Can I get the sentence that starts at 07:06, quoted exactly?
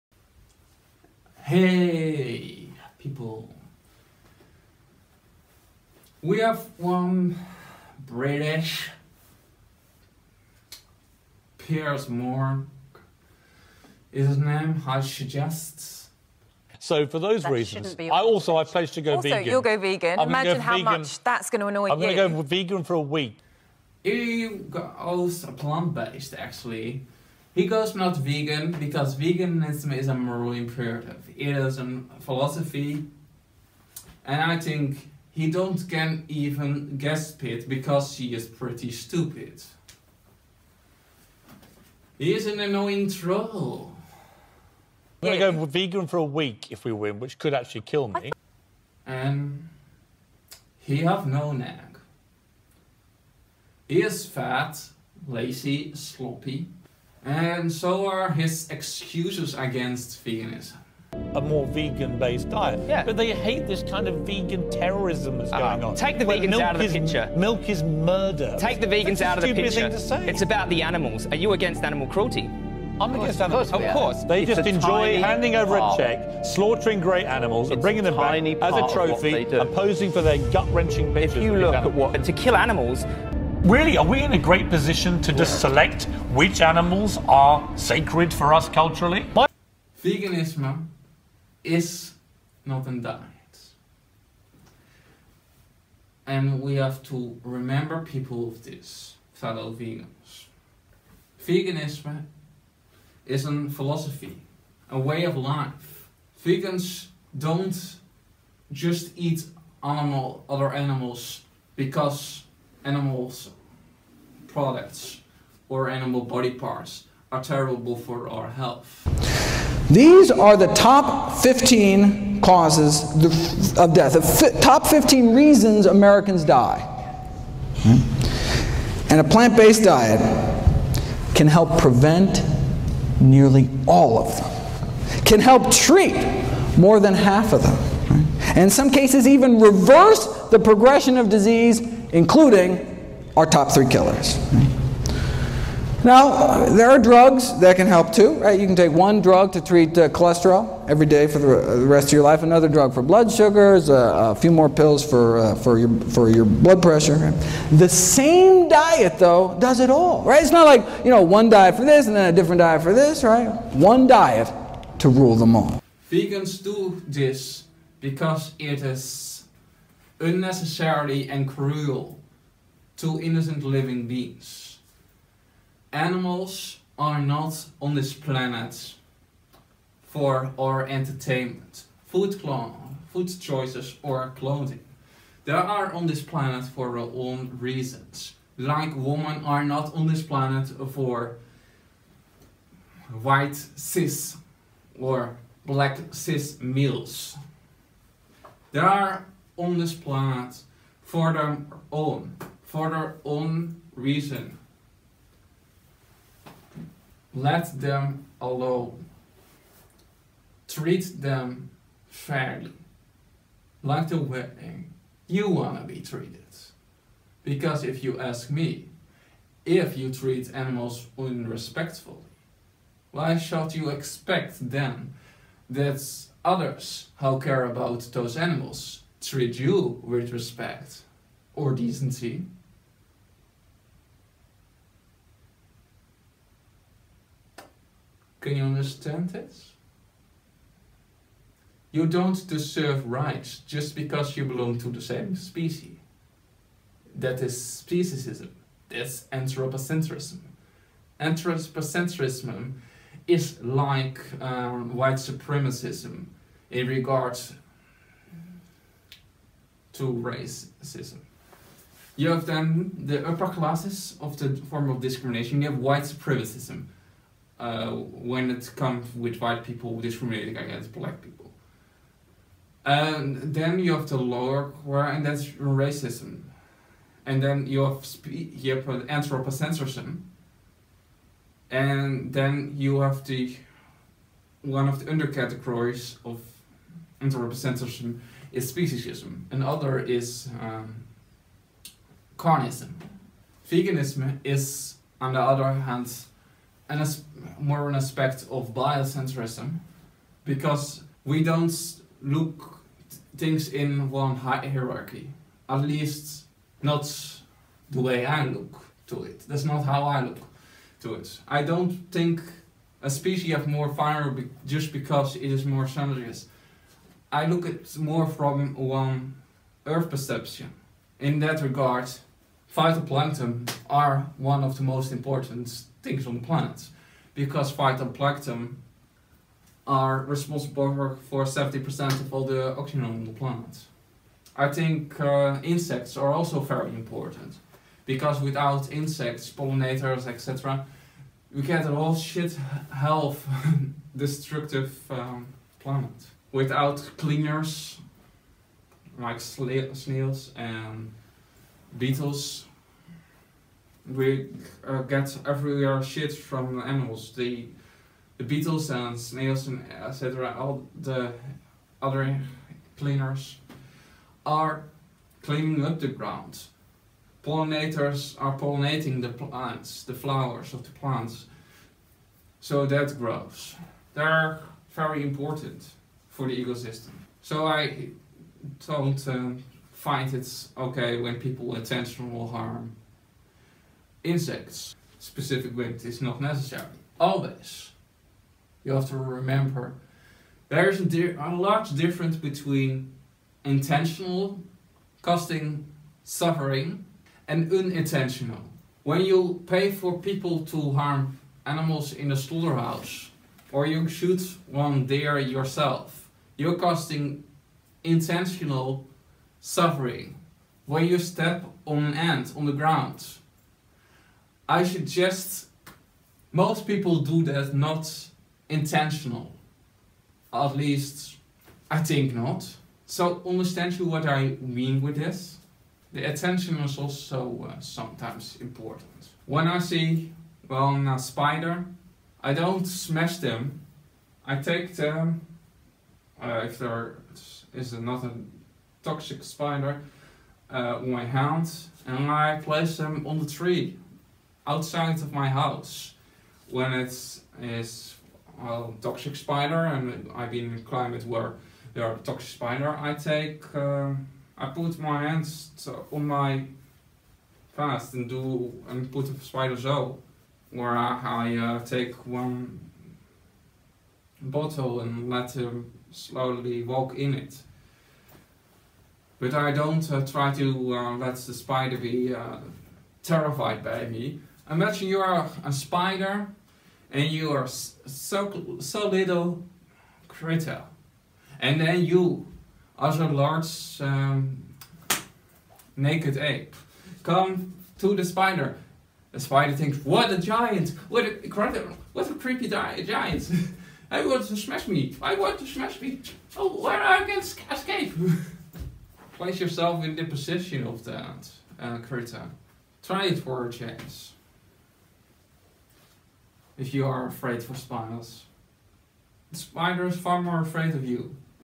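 The attention is also uh, sometimes important.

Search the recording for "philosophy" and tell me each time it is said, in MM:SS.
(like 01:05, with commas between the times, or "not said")
00:32, 01:43.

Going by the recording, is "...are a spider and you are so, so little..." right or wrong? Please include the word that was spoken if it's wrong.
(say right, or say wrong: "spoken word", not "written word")
right.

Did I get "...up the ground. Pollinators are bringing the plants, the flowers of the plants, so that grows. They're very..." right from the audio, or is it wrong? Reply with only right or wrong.
wrong.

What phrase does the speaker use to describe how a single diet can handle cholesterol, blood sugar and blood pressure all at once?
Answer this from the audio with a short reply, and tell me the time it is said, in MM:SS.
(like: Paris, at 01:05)
One diet to rule them all, at 02:43.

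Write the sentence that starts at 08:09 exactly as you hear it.
The spider thinks, what a giant!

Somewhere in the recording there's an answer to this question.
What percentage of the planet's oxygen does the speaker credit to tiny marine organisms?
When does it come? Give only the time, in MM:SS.
05:31.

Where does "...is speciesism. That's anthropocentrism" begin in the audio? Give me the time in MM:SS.
04:07.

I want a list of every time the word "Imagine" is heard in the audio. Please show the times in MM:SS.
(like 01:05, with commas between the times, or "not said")
00:20, 07:54.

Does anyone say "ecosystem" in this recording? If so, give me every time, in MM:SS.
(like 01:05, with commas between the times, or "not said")
06:16.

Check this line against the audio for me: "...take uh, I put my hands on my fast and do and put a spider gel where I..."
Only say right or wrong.
right.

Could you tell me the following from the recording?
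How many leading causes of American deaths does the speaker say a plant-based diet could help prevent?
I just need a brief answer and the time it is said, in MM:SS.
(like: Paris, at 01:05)
15, at 02:04.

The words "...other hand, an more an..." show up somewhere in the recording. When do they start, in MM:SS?
04:55.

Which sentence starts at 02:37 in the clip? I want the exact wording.
The same diet, though, does it all.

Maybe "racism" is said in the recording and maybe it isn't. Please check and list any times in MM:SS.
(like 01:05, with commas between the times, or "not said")
04:20, 04:35.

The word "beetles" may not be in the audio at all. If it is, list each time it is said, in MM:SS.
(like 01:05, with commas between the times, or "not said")
05:51, 05:58.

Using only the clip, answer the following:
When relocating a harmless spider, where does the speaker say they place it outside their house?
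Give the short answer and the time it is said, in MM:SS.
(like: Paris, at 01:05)
On the tree, at 07:23.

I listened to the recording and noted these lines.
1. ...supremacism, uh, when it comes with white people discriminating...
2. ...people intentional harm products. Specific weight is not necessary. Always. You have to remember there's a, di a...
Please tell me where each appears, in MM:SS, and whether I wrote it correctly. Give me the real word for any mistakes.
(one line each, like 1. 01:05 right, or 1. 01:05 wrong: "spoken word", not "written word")
1. 04:26 right
2. 06:21 wrong: "insects", not "products".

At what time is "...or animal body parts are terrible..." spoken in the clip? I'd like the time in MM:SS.
01:55.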